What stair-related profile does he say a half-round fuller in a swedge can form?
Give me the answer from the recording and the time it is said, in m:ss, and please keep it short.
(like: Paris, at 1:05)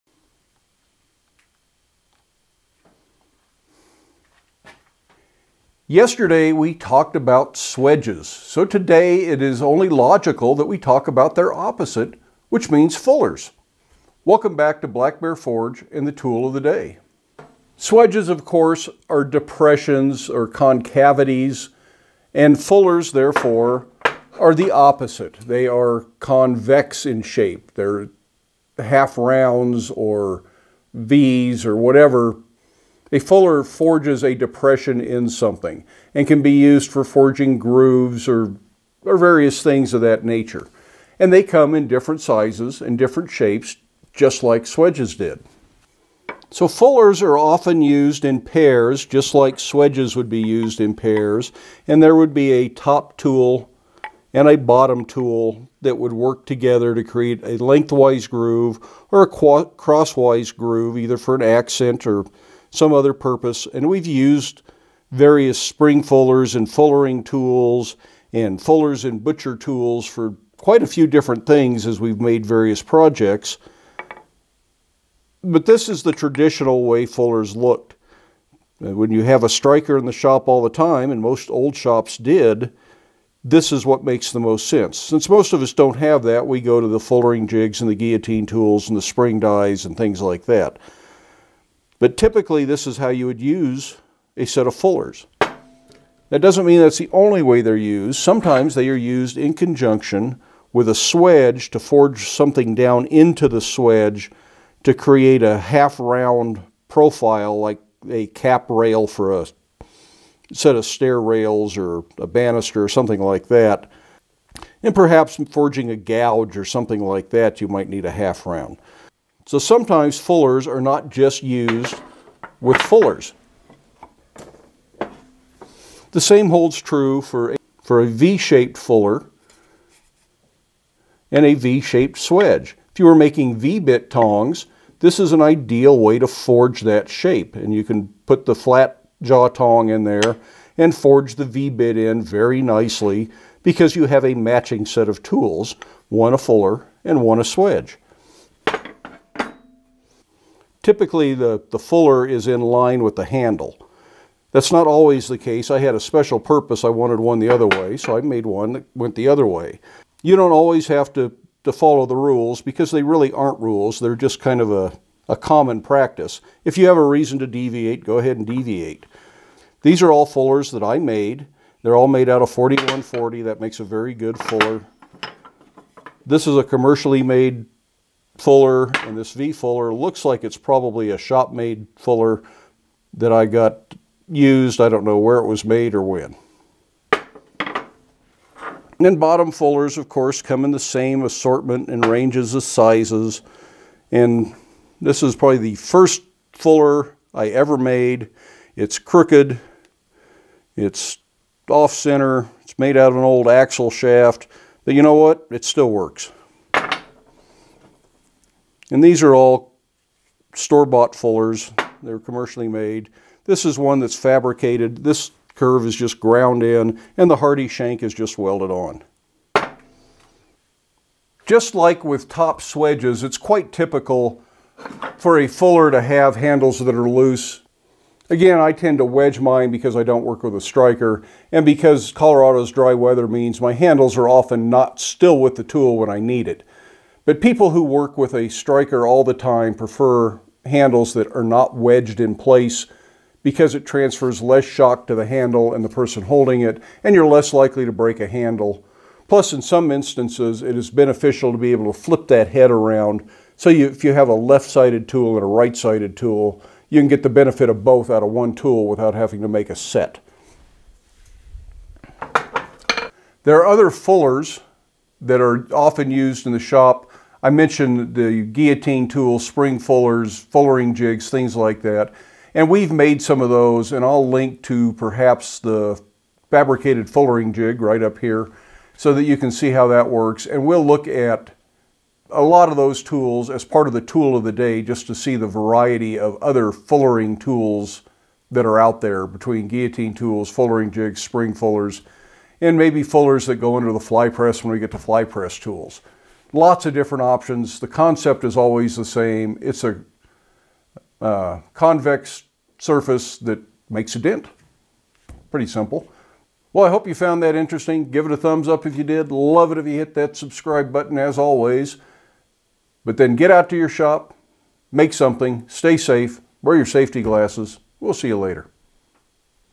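cap rail, at 1:48.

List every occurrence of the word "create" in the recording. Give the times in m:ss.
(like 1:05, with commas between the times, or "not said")
0:57, 1:44.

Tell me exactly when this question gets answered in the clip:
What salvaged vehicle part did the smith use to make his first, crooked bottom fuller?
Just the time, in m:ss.
3:23.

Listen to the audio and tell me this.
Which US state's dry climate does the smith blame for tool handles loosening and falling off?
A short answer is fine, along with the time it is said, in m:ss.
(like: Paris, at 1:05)
Colorado, at 3:52.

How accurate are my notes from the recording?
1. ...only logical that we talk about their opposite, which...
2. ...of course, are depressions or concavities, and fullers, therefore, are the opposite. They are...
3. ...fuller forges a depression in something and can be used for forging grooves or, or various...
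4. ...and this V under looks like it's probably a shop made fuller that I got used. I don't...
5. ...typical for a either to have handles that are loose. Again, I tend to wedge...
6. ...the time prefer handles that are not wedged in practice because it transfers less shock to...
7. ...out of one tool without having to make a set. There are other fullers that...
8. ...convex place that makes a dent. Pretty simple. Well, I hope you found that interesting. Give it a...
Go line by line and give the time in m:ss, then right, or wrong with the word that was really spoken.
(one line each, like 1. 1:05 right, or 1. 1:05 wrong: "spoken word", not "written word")
1. 0:09 right
2. 0:18 right
3. 0:33 right
4. 2:59 wrong: "fuller", not "under"
5. 3:43 wrong: "fuller", not "either"
6. 3:59 wrong: "place", not "practice"
7. 4:18 right
8. 5:01 wrong: "surface", not "place".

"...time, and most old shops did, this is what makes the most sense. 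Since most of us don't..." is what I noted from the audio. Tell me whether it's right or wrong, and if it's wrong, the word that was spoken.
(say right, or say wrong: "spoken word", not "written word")
right.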